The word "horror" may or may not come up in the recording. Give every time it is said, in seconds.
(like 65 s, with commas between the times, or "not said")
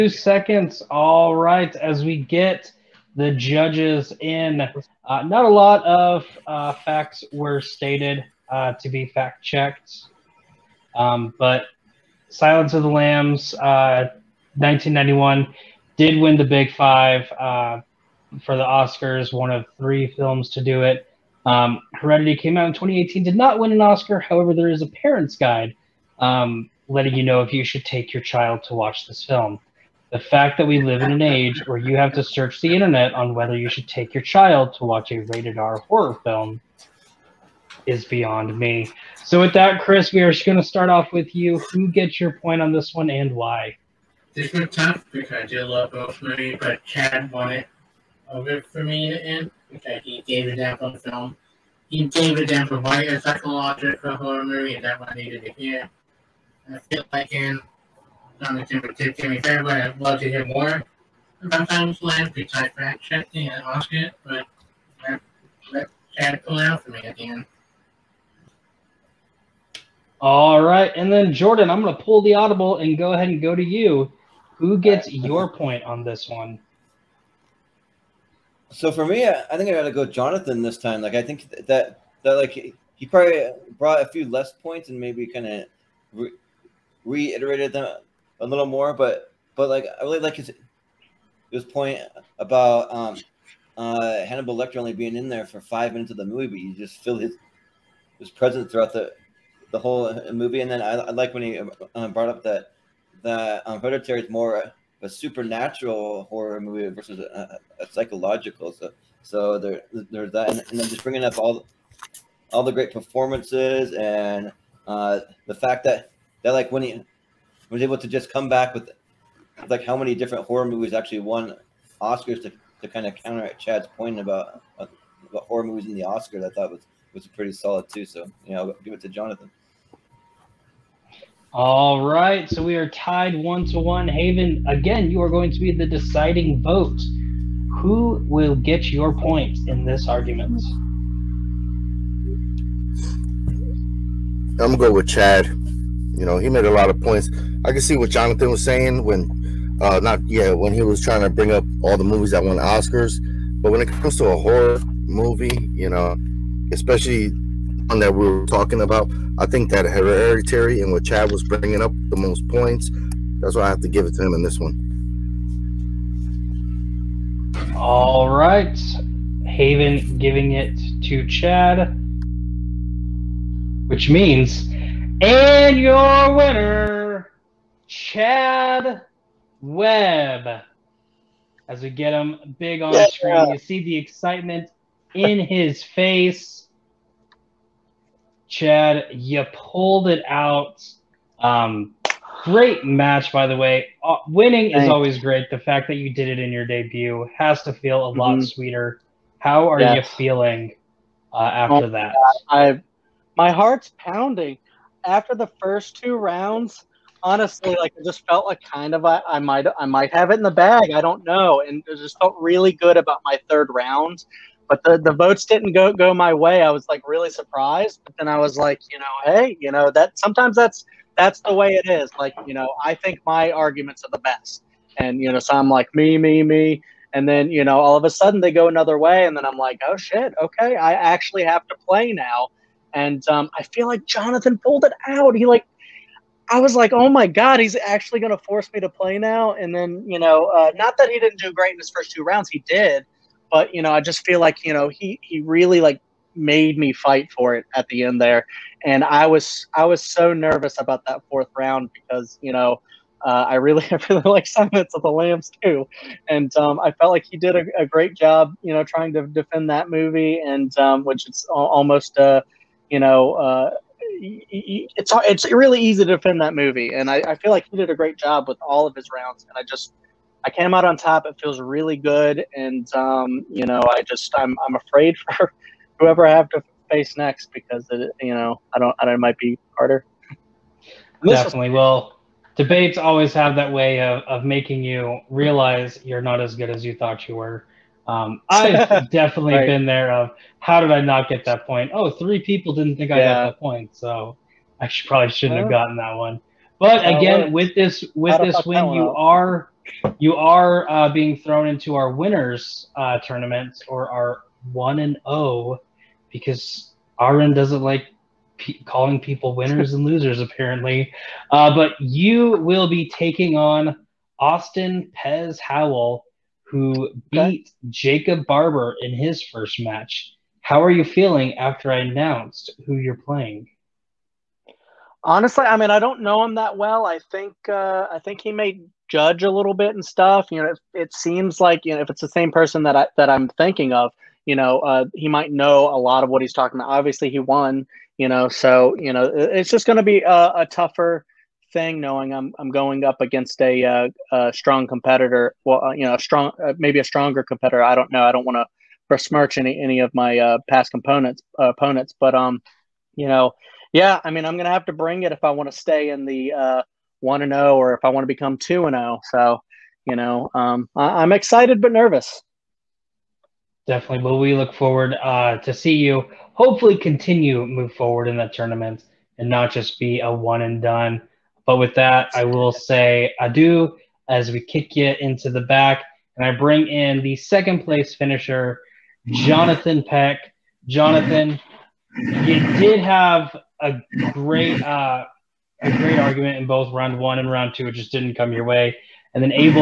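35 s, 54 s, 106 s, 120 s, 125 s, 154 s.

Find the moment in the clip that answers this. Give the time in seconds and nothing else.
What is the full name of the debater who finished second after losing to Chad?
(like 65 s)
379 s.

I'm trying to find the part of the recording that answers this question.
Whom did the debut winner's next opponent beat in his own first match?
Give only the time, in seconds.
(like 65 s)
317 s.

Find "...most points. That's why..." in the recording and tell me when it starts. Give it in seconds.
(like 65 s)
162 s.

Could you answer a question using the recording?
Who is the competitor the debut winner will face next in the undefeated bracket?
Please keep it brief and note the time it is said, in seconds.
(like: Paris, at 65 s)
Austin Pez Howell, at 314 s.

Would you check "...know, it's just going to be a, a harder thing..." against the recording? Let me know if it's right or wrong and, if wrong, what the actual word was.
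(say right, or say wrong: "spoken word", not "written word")
wrong: "tougher", not "harder".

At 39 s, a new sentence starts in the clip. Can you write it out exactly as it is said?
So with that, Chris, we are just going to start off with you.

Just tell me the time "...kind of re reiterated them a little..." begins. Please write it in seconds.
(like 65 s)
85 s.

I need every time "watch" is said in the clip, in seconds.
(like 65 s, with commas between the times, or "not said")
28 s, 34 s.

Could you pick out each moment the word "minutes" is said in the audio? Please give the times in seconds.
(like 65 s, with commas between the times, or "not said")
95 s.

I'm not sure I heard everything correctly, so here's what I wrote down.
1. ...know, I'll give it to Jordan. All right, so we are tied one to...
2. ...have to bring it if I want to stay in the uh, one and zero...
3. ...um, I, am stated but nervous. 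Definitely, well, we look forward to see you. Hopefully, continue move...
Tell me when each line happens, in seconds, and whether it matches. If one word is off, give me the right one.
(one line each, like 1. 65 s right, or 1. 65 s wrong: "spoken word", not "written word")
1. 128 s wrong: "Jonathan", not "Jordan"
2. 354 s right
3. 360 s wrong: "excited", not "stated".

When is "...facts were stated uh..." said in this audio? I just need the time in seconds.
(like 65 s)
6 s.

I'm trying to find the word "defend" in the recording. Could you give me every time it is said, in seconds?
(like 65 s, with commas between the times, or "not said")
259 s, 266 s.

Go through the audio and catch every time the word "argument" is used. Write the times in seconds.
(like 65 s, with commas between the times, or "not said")
140 s, 223 s, 386 s.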